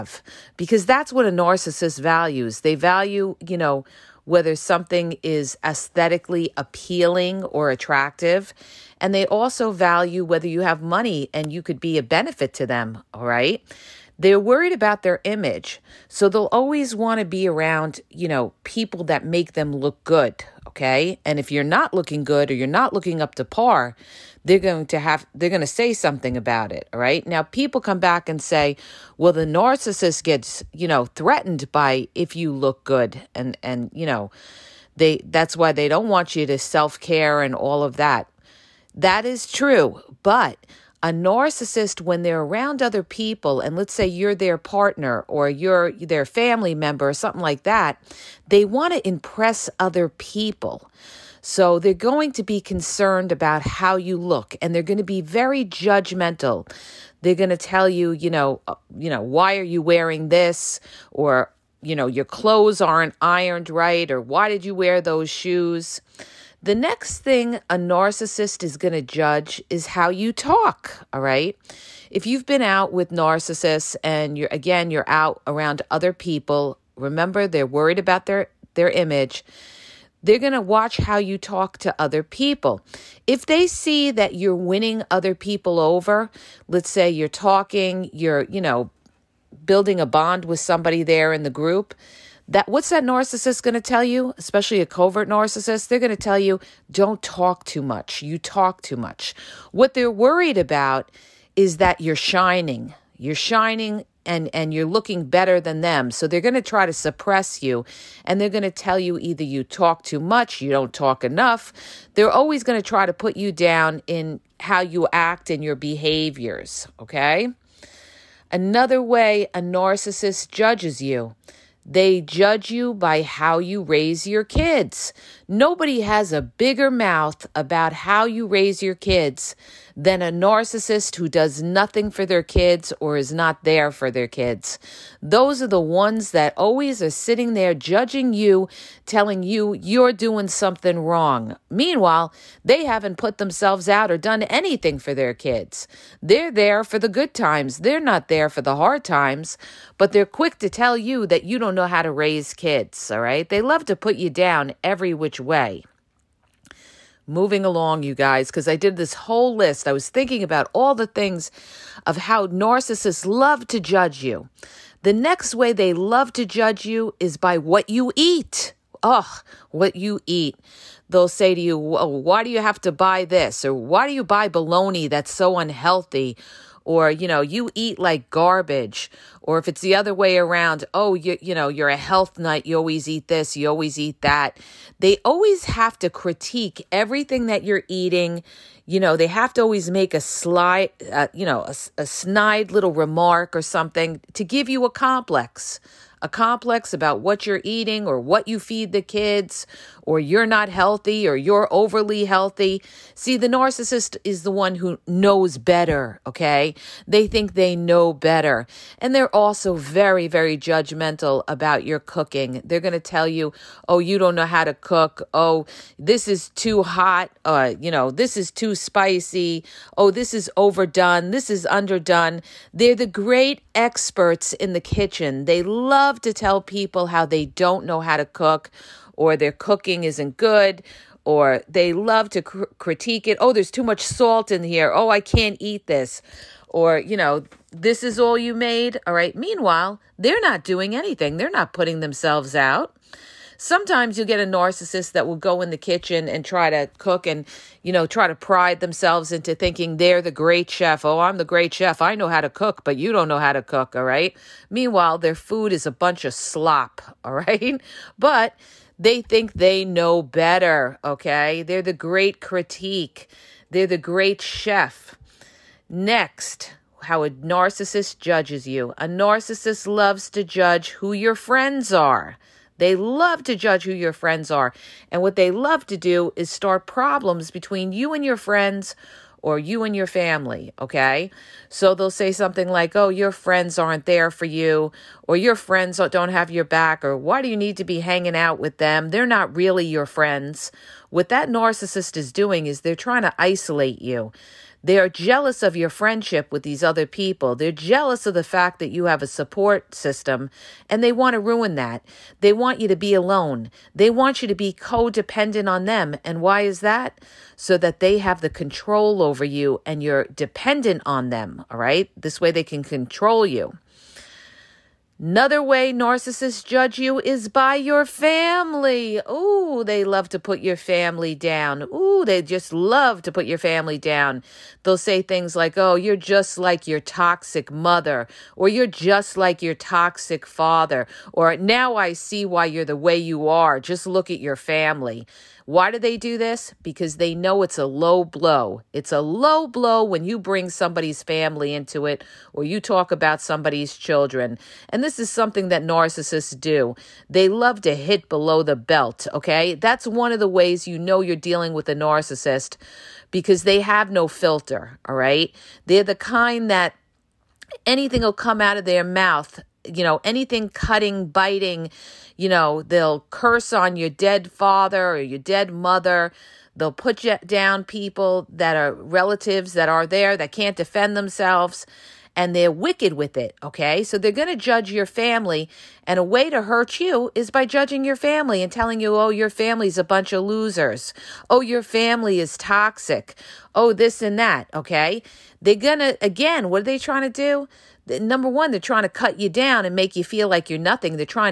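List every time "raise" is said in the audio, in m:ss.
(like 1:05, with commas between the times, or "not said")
2:03, 2:08, 2:32.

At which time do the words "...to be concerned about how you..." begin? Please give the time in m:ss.
0:52.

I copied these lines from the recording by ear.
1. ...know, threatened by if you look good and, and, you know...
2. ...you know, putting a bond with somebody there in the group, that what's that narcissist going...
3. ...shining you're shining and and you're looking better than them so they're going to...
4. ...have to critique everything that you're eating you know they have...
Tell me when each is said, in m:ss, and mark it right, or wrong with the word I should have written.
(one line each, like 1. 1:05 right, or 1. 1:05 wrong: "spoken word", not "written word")
1. 0:30 right
2. 1:28 wrong: "building", not "putting"
3. 1:42 right
4. 3:05 right.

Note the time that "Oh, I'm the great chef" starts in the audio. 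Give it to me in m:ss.
4:11.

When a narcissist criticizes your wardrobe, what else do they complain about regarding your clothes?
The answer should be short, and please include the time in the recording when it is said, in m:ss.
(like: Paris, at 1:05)
aren't ironed right, at 1:02.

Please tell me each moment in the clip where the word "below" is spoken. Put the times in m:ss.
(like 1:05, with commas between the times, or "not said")
5:48.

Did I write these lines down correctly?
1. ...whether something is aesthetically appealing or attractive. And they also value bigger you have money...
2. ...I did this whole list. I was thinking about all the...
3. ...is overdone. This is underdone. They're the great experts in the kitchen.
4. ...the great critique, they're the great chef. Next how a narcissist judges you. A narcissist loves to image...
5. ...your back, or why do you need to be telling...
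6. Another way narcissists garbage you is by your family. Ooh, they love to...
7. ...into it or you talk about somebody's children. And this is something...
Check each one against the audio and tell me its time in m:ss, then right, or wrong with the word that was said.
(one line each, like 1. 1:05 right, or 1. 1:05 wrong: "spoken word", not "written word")
1. 0:04 wrong: "whether", not "bigger"
2. 2:38 right
3. 3:40 right
4. 4:21 wrong: "judge", not "image"
5. 4:46 wrong: "hanging", not "telling"
6. 5:15 wrong: "judge", not "garbage"
7. 5:41 right.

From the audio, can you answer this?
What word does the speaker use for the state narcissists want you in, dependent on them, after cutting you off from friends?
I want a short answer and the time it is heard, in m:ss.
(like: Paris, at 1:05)
codependent, at 5:04.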